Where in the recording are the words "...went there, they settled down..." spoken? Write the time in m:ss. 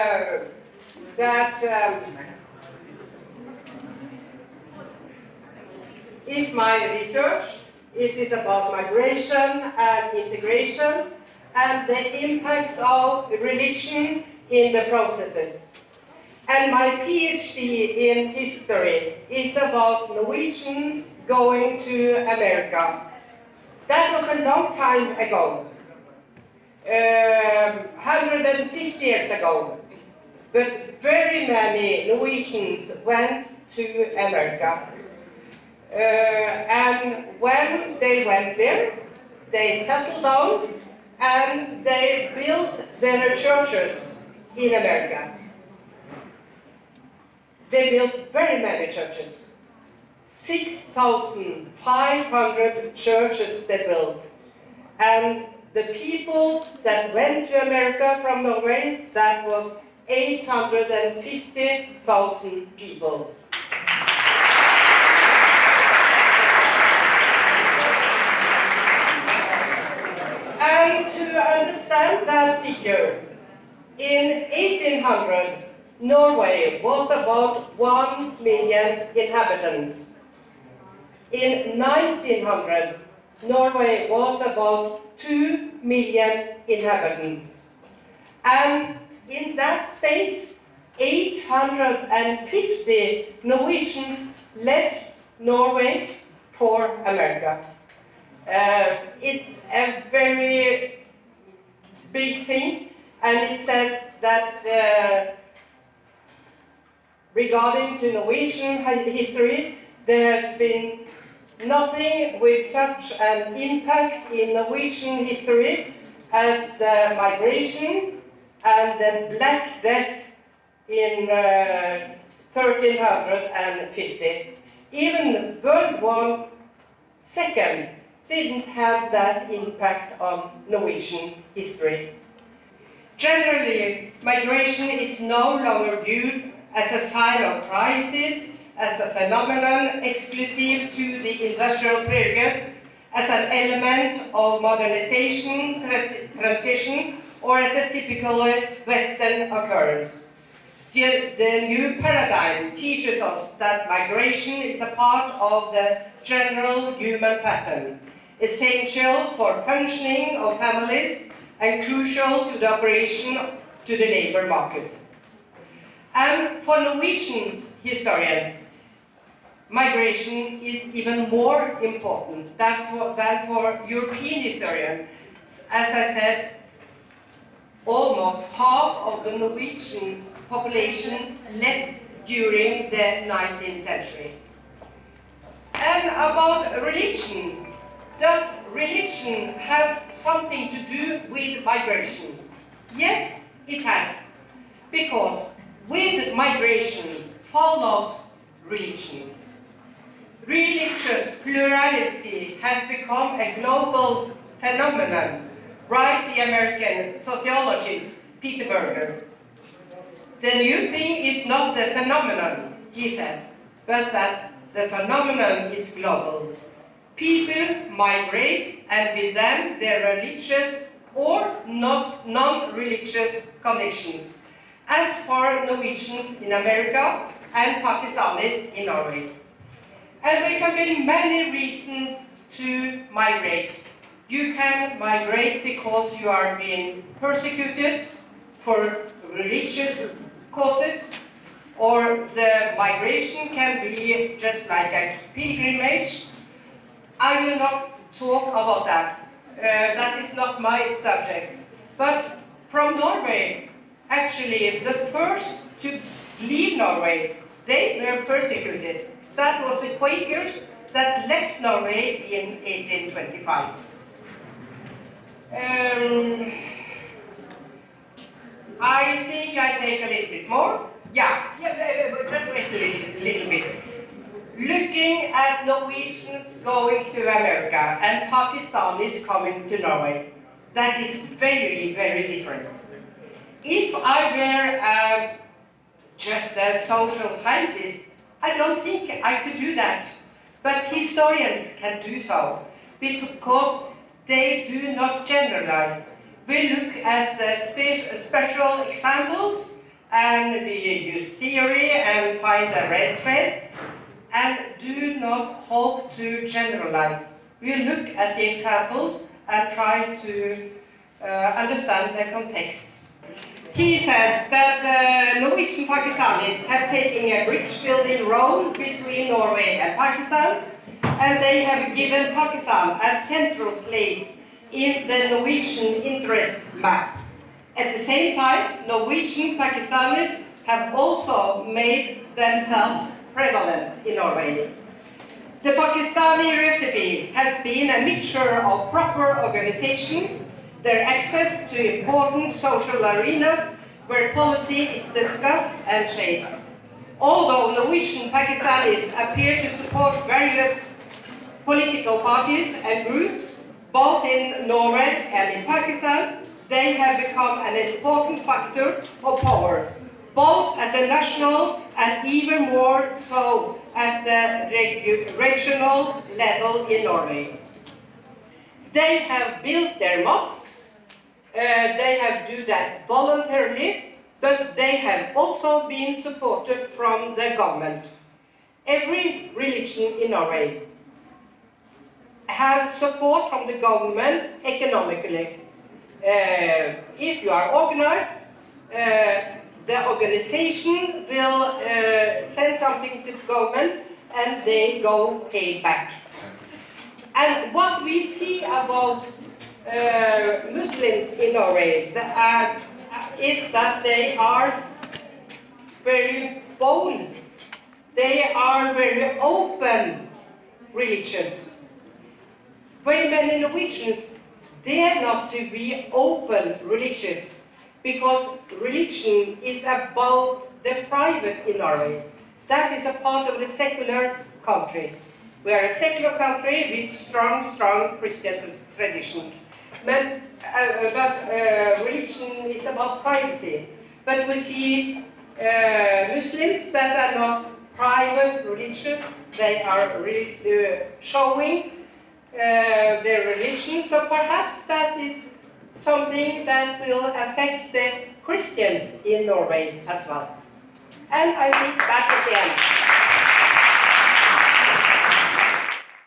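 0:38.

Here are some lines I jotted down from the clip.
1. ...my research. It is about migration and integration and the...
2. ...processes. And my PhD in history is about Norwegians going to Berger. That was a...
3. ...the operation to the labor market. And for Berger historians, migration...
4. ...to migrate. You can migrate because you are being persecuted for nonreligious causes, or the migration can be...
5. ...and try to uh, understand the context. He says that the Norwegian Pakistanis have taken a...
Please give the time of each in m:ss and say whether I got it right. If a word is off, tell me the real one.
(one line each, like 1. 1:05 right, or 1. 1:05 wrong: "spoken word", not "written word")
1. 0:06 right
2. 0:14 wrong: "America", not "Berger"
3. 2:42 wrong: "Norwegian", not "Berger"
4. 3:52 wrong: "religious", not "nonreligious"
5. 5:09 right.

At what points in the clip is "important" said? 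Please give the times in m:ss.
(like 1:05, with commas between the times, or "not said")
2:51, 5:41, 5:57.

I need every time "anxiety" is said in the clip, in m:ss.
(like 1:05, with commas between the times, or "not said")
not said.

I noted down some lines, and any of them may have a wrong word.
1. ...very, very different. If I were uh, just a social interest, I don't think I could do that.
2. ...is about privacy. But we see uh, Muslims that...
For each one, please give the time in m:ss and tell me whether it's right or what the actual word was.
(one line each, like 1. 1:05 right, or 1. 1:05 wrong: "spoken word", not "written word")
1. 4:41 wrong: "scientist", not "interest"
2. 7:12 right.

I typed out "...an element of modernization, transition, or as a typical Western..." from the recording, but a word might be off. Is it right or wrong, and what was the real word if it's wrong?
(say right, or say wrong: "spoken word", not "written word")
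right.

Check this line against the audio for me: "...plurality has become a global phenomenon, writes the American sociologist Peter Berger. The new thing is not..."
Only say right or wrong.
right.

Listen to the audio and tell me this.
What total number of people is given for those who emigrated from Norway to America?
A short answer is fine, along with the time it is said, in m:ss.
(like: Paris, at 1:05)
850,000, at 1:00.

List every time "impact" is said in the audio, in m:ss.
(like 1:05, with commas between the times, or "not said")
0:12, 1:53, 2:09.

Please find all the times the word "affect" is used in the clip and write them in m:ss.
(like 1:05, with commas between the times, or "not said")
7:27.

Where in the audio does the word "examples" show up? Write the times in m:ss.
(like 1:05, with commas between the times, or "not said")
4:58, 5:08.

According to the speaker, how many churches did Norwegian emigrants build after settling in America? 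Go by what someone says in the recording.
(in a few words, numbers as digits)
6,500.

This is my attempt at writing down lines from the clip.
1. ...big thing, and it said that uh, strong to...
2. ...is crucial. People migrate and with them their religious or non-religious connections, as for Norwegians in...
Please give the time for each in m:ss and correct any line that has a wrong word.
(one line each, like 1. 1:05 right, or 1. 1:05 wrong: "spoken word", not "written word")
1. 1:42 wrong: "regarding", not "strong"
2. 3:35 wrong: "global", not "crucial".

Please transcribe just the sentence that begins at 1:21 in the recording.
In 1900, Norway was about 2 million inhabitants.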